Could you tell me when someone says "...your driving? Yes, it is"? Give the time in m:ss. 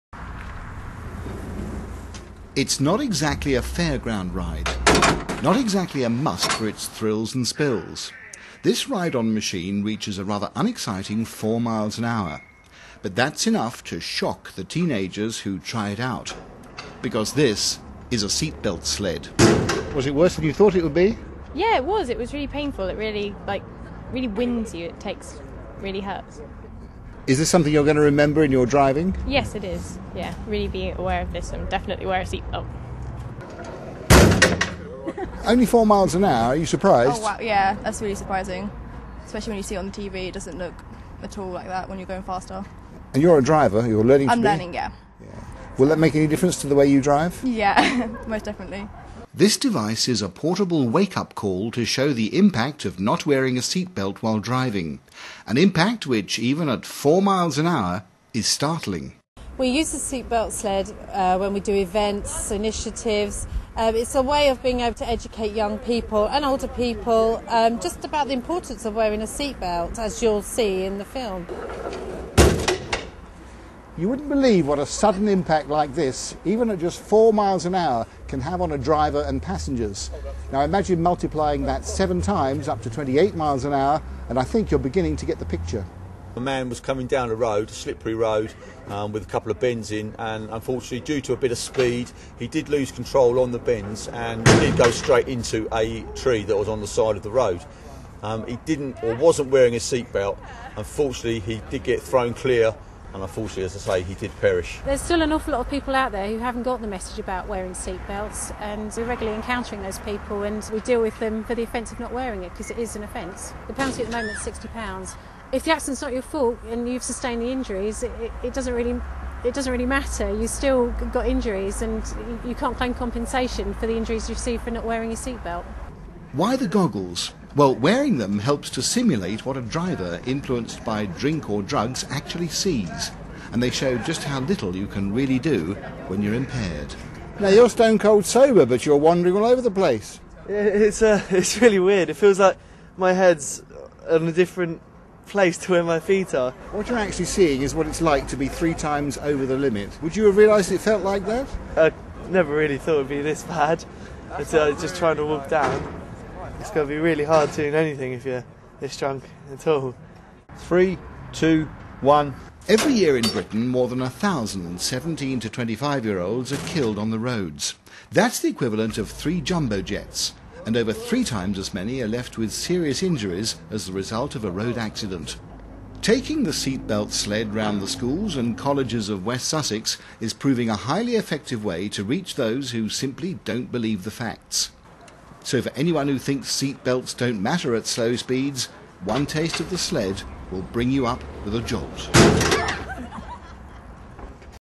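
0:28.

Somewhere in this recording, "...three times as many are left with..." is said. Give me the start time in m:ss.
2:50.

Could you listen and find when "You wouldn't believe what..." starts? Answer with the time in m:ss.
1:14.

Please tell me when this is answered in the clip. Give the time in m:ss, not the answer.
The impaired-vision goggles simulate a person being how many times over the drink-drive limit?
2:28.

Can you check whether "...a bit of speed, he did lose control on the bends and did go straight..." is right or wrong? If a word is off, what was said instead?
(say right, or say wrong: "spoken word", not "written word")
right.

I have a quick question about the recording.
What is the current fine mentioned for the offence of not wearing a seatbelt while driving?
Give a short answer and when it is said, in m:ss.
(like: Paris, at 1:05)
£60, at 1:54.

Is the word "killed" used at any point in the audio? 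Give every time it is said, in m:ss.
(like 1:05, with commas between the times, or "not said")
2:46.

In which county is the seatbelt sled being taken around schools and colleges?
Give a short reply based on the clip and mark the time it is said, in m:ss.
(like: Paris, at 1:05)
West Sussex, at 2:59.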